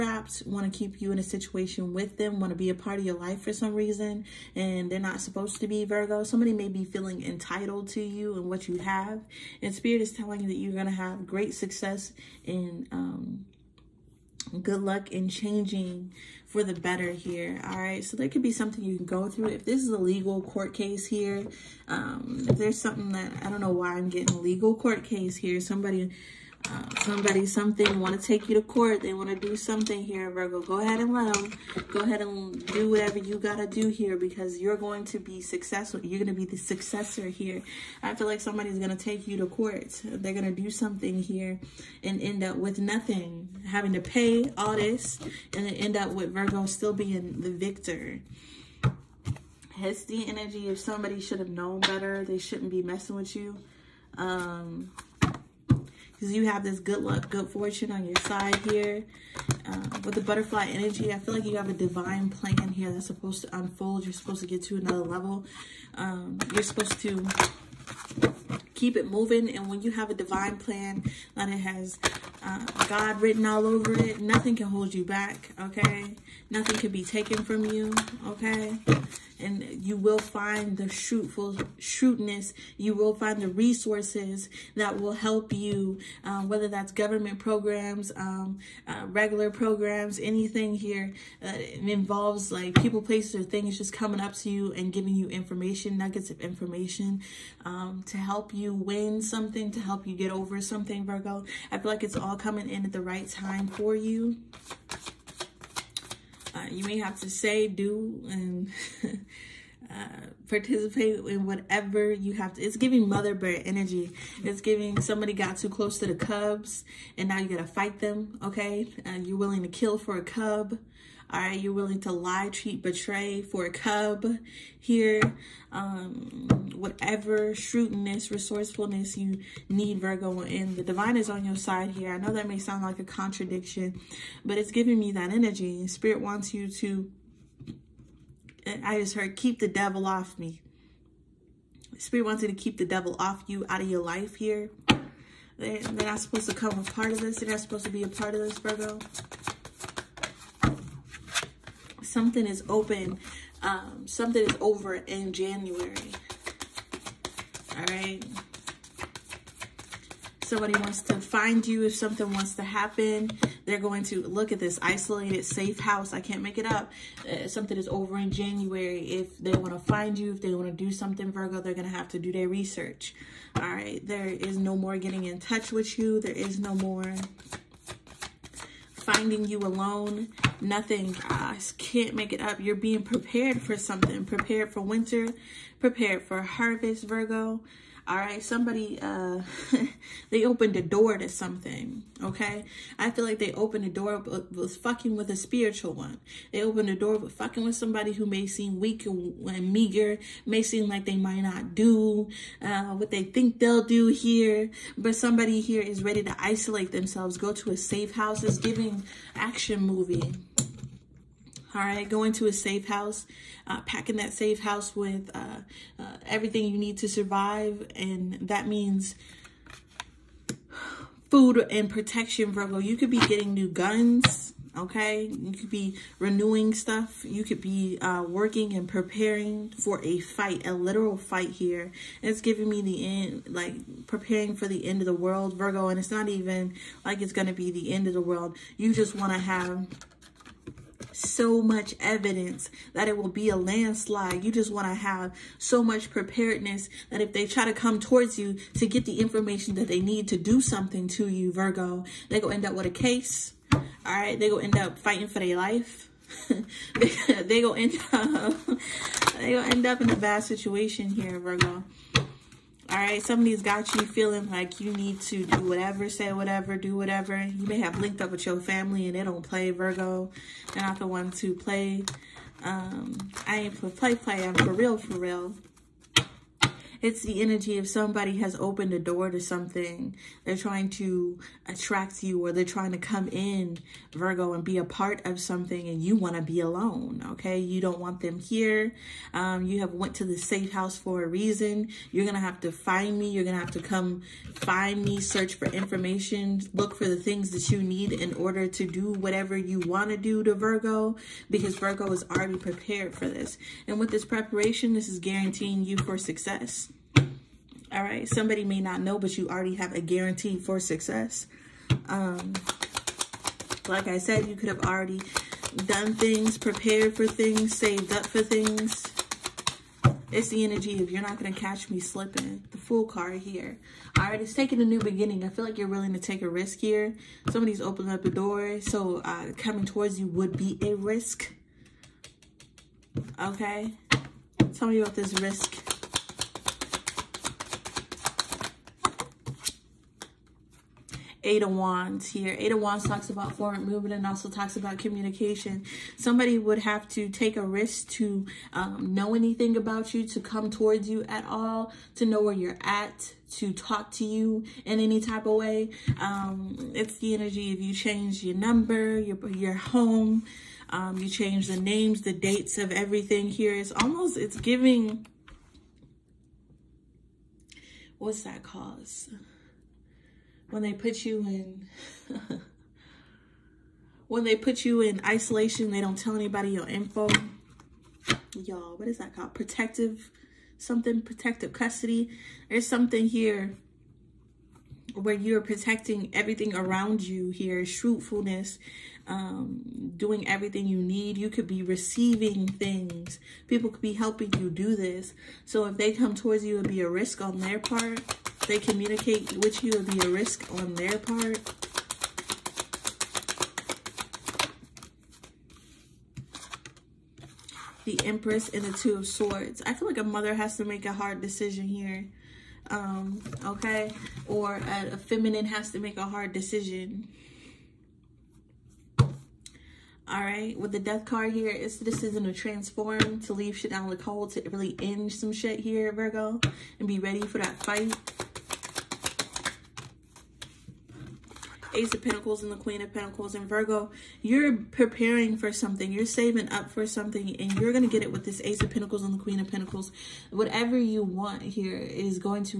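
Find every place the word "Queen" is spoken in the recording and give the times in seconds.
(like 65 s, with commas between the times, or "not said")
432 s, 439 s.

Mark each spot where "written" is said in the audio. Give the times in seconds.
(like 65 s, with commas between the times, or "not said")
73 s.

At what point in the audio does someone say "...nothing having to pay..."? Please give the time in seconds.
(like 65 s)
42 s.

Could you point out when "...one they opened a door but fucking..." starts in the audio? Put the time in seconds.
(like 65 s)
195 s.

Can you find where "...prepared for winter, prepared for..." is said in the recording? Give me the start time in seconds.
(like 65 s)
184 s.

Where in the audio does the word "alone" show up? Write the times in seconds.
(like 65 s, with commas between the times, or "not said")
179 s, 286 s.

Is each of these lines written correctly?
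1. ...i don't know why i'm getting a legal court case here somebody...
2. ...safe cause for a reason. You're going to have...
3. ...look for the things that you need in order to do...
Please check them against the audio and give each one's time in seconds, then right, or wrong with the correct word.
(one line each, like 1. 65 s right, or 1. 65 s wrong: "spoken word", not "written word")
1. 23 s right
2. 290 s wrong: "house", not "cause"
3. 296 s right.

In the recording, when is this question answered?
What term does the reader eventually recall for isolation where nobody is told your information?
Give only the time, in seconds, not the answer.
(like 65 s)
381 s.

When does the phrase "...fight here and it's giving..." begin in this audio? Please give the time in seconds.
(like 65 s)
231 s.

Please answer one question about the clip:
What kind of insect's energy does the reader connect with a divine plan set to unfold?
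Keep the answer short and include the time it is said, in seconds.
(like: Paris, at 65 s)
Butterfly, at 60 s.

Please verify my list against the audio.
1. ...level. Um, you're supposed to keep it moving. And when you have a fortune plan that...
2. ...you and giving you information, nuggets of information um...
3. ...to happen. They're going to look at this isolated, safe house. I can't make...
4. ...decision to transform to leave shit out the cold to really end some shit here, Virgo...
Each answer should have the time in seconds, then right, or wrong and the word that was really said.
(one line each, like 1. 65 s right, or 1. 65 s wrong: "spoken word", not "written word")
1. 65 s wrong: "divine", not "fortune"
2. 94 s right
3. 162 s right
4. 422 s right.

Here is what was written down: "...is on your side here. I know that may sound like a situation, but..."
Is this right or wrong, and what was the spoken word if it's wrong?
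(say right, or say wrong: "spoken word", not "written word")
wrong: "contradiction", not "situation".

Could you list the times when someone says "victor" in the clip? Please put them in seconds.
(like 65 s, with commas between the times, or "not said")
47 s.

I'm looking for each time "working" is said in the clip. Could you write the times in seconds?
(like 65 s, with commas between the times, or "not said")
228 s.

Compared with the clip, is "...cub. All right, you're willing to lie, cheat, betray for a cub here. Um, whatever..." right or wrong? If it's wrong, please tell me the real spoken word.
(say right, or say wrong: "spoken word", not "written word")
right.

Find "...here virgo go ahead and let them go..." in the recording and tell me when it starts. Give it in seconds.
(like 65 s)
30 s.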